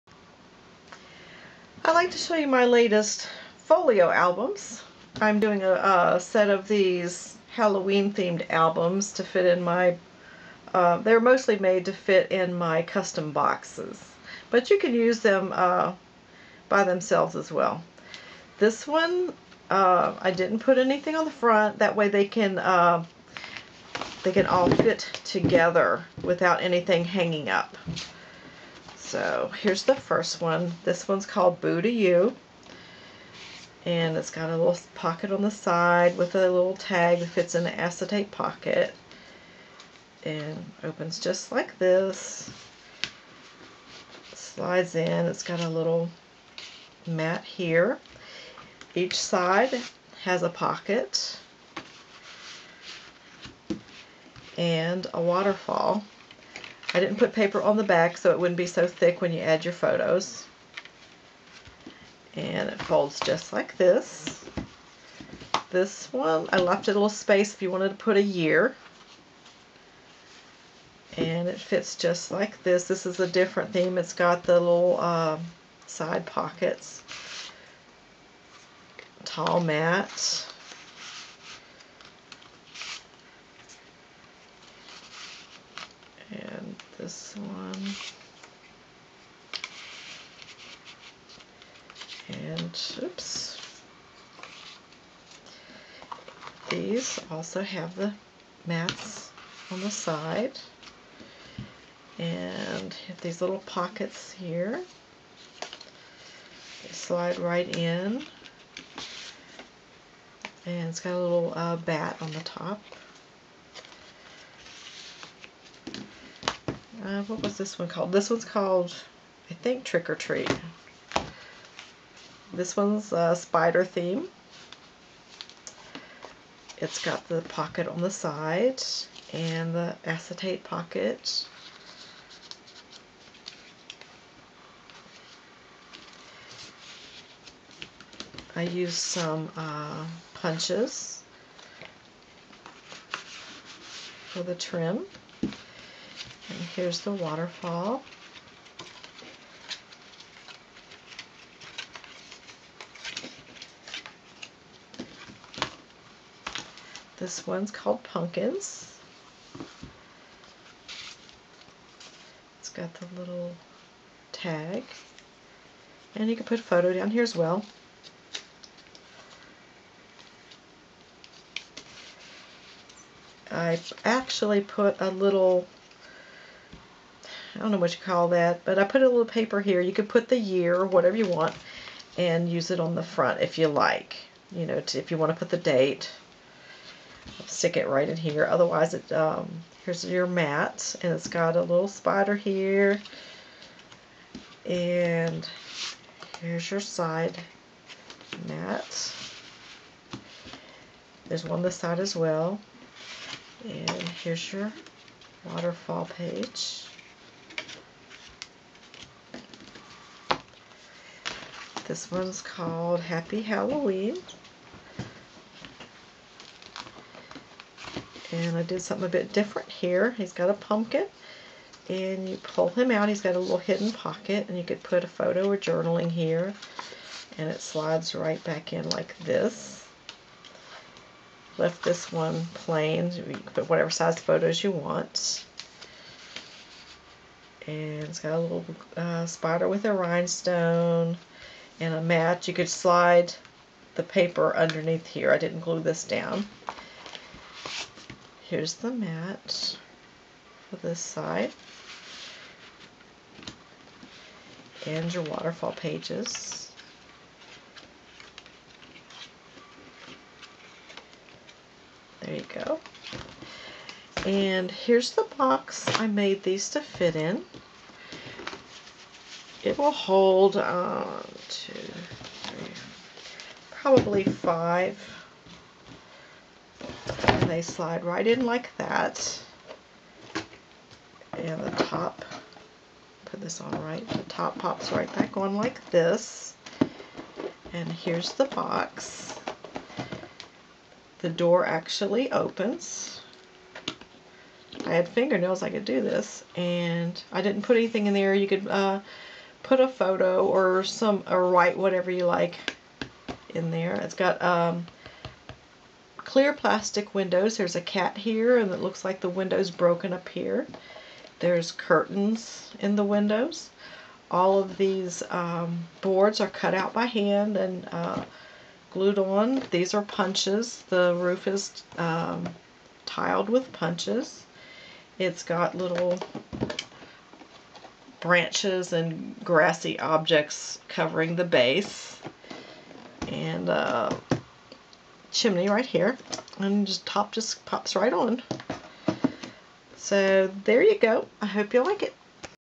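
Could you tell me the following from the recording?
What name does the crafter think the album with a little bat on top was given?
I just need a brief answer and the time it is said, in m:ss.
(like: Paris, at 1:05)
Trick or Treat, at 1:59.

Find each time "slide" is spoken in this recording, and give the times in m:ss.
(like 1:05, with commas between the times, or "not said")
0:44, 1:46, 3:47, 4:02, 4:37.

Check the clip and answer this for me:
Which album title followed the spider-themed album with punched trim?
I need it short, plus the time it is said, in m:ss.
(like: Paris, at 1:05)
Pumpkins, at 2:38.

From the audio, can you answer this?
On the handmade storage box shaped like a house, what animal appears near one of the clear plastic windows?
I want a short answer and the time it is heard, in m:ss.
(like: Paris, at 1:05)
a cat, at 5:07.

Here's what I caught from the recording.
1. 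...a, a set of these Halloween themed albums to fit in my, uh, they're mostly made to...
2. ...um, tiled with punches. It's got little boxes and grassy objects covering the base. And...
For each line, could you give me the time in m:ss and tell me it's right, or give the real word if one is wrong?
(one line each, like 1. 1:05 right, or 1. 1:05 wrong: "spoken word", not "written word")
1. 0:05 right
2. 5:21 wrong: "branches", not "boxes".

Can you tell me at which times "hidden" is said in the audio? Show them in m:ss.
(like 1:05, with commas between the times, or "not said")
3:43.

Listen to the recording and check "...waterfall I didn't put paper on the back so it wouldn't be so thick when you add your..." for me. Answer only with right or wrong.
right.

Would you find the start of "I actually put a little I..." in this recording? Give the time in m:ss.
2:53.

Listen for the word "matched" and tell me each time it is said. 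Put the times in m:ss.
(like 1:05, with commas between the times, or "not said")
not said.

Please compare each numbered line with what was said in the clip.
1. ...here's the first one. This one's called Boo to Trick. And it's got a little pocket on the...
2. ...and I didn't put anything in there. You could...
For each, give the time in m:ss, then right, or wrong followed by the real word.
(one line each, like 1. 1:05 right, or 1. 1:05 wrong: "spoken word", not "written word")
1. 0:29 wrong: "You", not "Trick"
2. 4:56 right.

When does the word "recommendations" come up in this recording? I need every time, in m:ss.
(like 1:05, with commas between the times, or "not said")
not said.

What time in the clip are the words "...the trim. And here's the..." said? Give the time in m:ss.
2:24.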